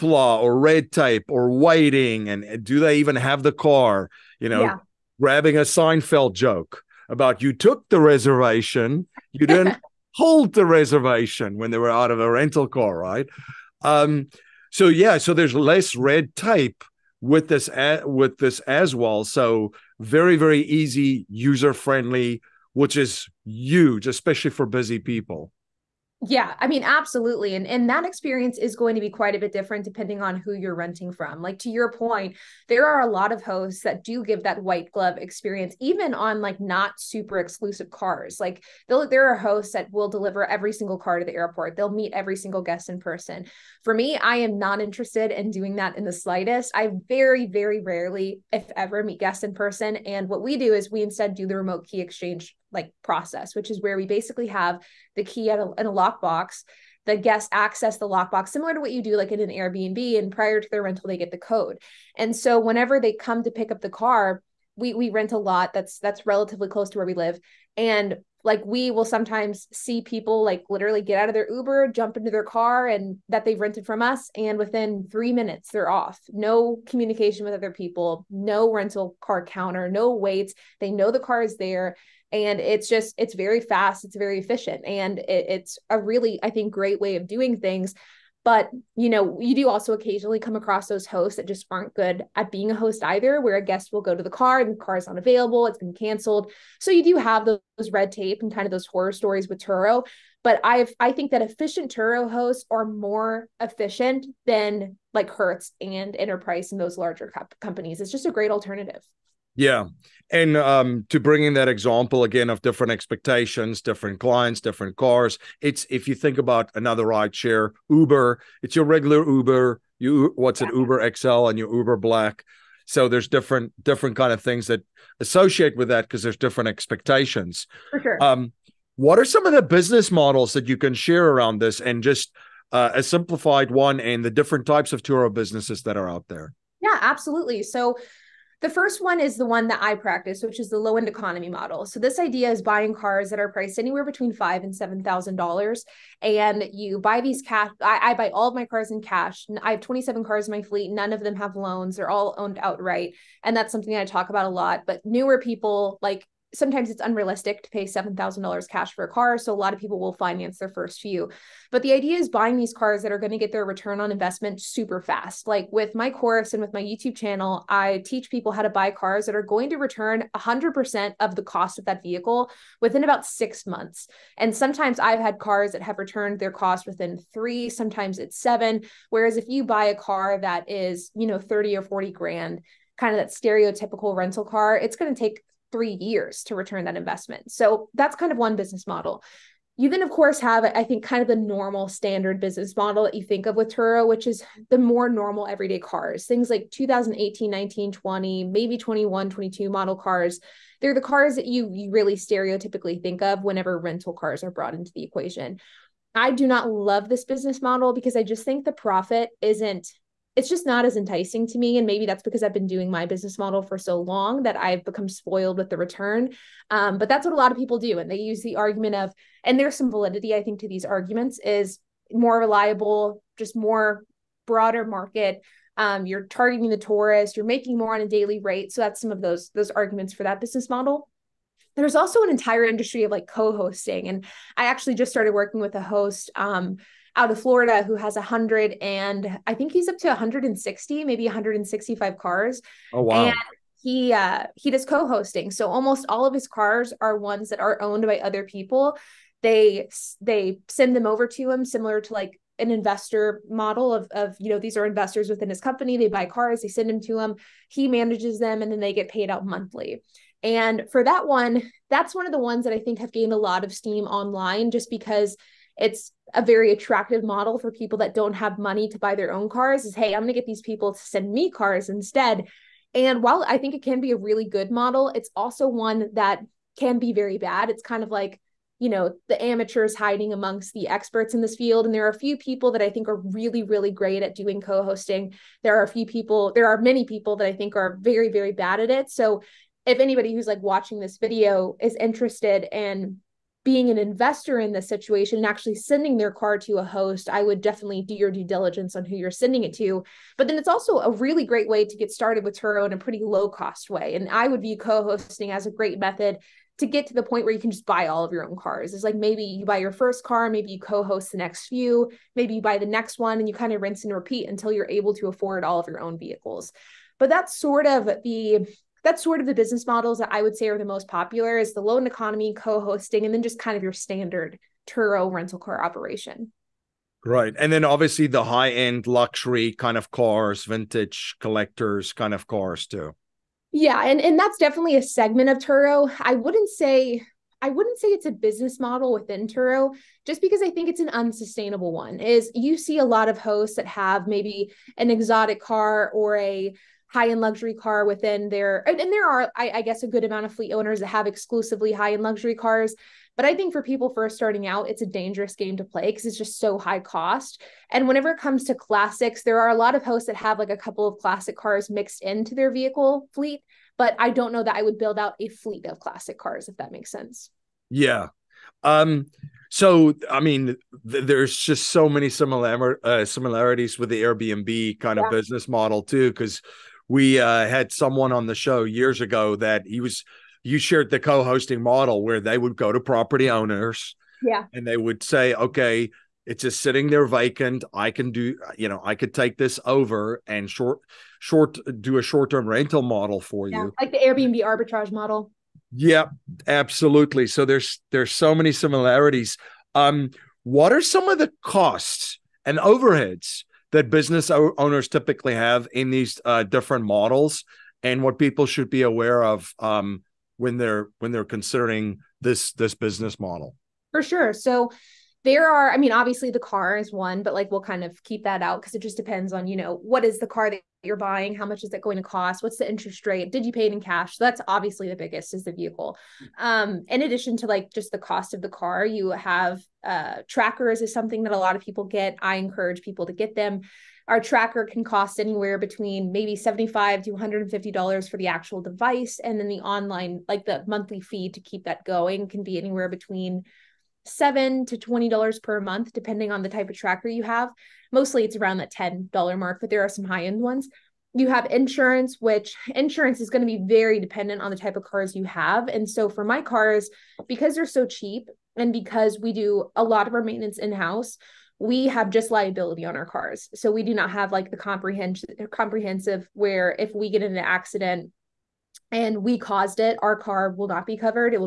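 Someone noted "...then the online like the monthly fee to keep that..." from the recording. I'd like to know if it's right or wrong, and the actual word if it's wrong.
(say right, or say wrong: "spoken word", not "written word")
right.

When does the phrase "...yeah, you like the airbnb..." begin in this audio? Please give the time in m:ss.
6:33.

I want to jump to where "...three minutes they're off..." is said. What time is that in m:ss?
1:15.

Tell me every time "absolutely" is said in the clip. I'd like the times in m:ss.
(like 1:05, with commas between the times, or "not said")
0:26, 2:17, 6:36.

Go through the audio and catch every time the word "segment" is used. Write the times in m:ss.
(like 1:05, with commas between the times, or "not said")
5:35.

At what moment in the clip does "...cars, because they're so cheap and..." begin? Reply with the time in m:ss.
7:36.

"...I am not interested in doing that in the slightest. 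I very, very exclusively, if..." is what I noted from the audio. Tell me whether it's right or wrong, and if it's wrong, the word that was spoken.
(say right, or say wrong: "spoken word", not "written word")
wrong: "rarely", not "exclusively".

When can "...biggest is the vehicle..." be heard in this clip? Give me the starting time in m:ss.
7:05.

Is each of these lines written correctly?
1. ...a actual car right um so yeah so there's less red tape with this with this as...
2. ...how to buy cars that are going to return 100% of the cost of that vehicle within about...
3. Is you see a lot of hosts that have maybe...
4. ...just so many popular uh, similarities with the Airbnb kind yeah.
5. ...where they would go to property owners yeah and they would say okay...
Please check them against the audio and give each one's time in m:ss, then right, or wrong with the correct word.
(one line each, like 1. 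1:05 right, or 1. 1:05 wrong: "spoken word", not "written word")
1. 0:12 wrong: "rental", not "actual"
2. 2:48 right
3. 5:42 right
4. 6:11 wrong: "similar", not "popular"
5. 6:22 right.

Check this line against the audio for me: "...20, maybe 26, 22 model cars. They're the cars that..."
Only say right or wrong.
wrong.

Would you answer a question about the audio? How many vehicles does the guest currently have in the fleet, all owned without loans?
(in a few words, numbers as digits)
27.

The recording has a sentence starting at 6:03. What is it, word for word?
But I don't know that I would build out a fleet of classic cars, if that makes sense.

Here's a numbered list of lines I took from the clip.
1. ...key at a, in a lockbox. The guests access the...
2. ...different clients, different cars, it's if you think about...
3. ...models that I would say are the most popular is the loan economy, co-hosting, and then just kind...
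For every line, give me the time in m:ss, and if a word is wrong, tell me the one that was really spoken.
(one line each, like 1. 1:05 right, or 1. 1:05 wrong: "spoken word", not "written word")
1. 0:55 right
2. 1:53 right
3. 5:19 right.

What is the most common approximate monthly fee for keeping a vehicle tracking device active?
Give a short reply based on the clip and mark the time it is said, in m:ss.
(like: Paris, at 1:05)
$10, at 7:28.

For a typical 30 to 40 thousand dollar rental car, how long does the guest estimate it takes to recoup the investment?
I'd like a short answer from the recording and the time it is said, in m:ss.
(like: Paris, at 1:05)
3 years, at 3:05.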